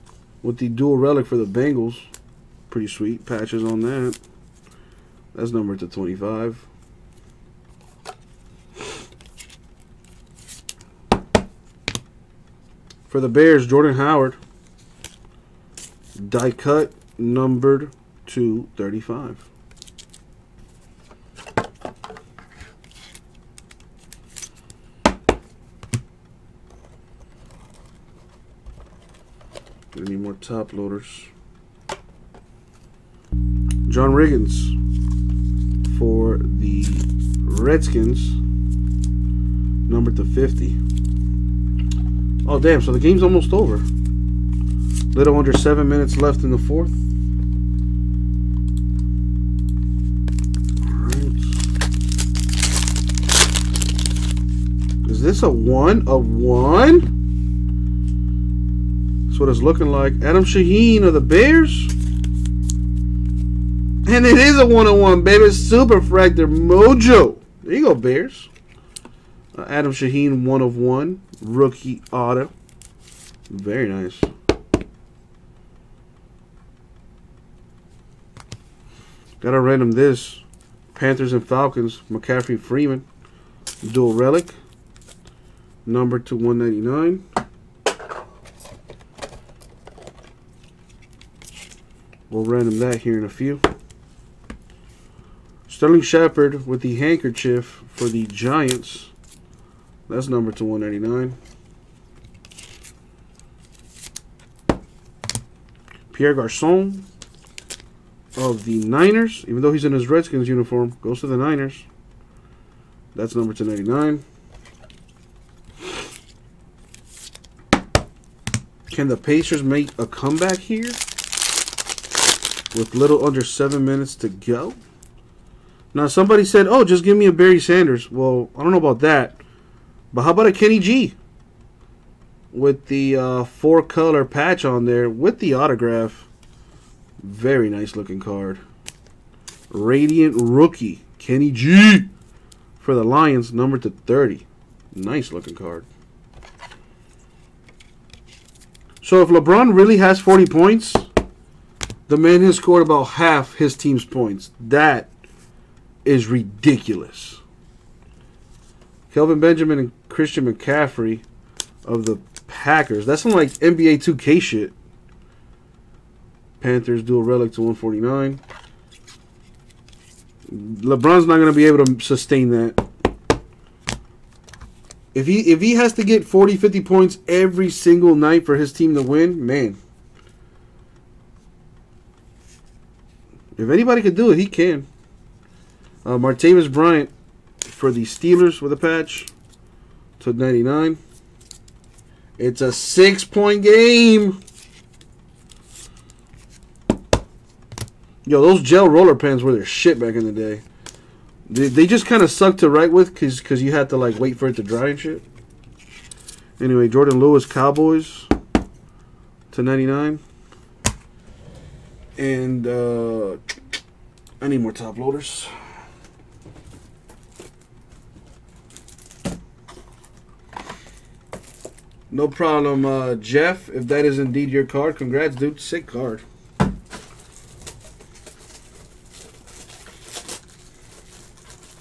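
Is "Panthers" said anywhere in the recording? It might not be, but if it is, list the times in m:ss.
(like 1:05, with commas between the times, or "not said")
1:20, 2:46.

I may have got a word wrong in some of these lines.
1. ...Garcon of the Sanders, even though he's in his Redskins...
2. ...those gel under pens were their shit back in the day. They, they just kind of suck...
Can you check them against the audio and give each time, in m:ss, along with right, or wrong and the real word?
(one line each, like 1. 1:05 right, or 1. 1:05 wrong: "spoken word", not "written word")
1. 1:46 wrong: "Niners", not "Sanders"
2. 3:18 wrong: "roller", not "under".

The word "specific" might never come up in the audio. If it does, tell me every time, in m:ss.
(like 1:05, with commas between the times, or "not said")
not said.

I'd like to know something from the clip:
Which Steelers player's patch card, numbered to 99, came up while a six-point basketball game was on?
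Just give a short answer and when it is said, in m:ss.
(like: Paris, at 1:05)
Martavis Bryant, at 3:06.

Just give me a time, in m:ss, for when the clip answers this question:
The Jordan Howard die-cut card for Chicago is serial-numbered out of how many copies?
0:18.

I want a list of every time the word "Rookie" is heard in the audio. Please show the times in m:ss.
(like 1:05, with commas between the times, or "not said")
1:11, 2:20.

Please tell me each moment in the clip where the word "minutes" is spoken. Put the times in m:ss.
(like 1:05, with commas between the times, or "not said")
0:45, 2:03.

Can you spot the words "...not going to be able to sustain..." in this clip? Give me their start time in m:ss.
2:51.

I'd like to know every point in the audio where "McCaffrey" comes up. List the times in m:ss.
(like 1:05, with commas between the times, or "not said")
1:22, 2:40.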